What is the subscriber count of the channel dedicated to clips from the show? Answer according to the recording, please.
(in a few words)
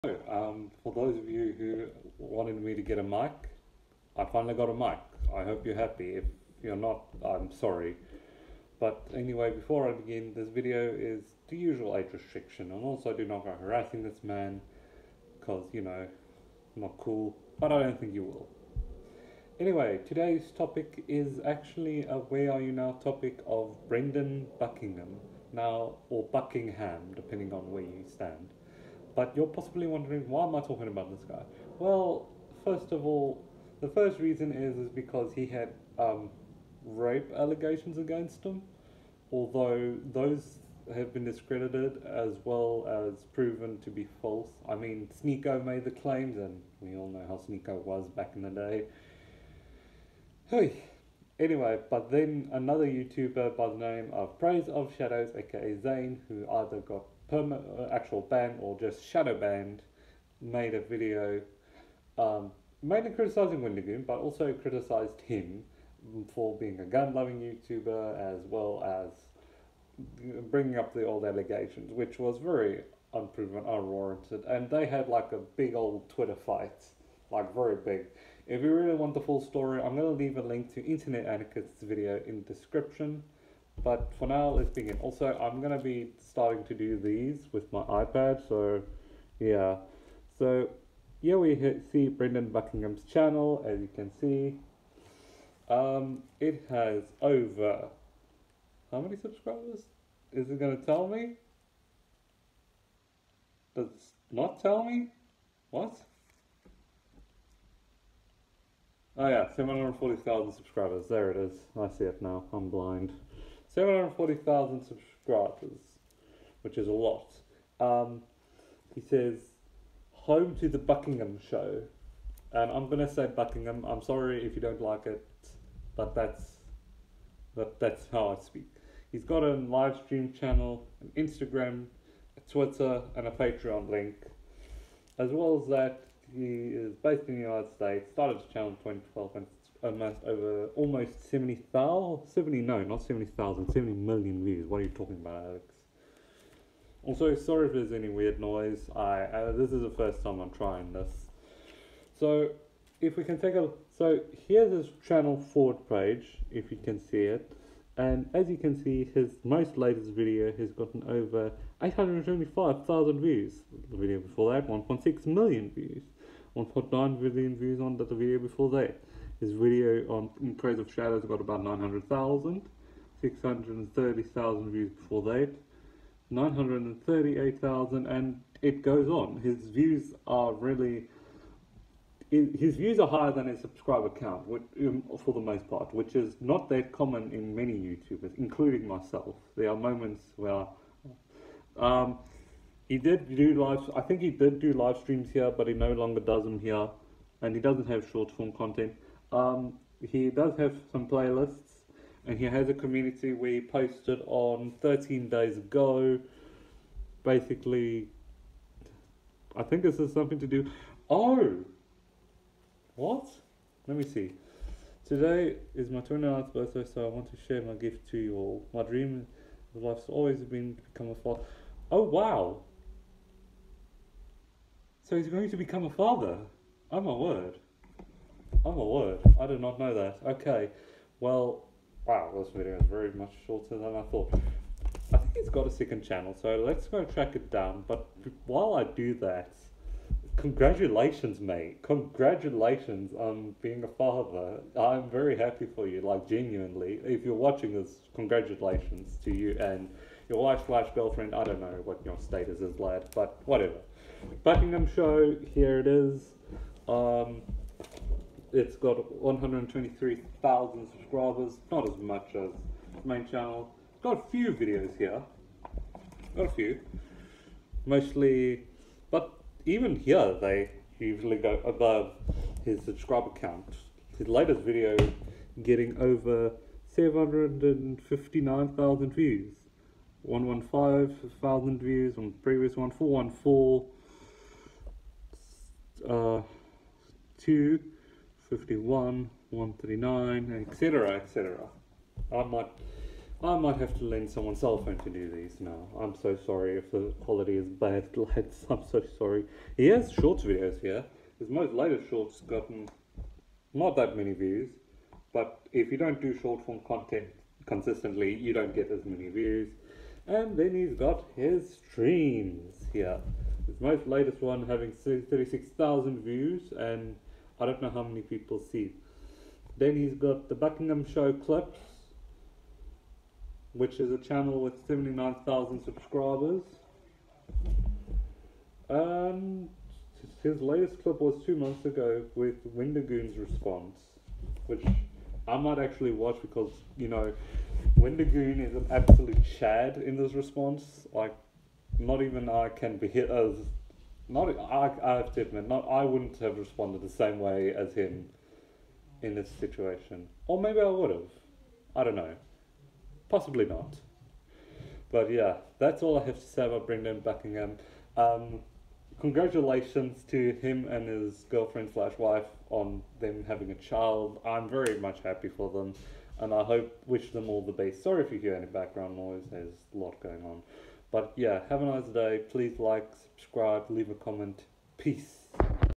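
79,000.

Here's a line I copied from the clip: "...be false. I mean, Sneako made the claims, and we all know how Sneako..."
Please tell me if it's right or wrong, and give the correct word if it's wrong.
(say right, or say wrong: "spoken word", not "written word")
right.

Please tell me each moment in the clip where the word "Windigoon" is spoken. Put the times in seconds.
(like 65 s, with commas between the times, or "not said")
337 s.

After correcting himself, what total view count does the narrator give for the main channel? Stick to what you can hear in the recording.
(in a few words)
70 million.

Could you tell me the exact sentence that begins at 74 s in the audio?
And they had like a big old Twitter fight, like very big.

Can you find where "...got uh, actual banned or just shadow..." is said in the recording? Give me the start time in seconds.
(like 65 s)
56 s.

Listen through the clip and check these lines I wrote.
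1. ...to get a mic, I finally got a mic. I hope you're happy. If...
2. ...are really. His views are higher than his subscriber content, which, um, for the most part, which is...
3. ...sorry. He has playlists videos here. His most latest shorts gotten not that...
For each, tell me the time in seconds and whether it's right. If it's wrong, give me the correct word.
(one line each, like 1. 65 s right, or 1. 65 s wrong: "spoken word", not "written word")
1. 2 s right
2. 180 s wrong: "count", not "content"
3. 299 s wrong: "shorts", not "playlists".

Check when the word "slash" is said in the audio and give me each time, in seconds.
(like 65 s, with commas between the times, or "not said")
250 s, 361 s.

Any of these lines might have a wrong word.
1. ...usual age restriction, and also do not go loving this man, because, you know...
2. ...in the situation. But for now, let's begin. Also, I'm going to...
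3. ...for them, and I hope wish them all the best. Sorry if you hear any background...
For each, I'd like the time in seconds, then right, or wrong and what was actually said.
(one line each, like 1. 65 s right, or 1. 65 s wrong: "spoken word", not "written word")
1. 11 s wrong: "harassing", not "loving"
2. 82 s wrong: "description", not "situation"
3. 365 s right.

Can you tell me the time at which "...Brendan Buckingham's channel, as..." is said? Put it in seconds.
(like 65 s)
92 s.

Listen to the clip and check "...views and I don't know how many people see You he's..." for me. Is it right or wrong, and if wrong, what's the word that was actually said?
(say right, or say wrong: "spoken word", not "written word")
wrong: "Then", not "You".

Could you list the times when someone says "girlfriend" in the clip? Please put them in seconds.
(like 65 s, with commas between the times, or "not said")
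250 s, 361 s.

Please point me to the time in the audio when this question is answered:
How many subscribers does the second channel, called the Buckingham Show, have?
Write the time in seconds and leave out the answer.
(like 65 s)
259 s.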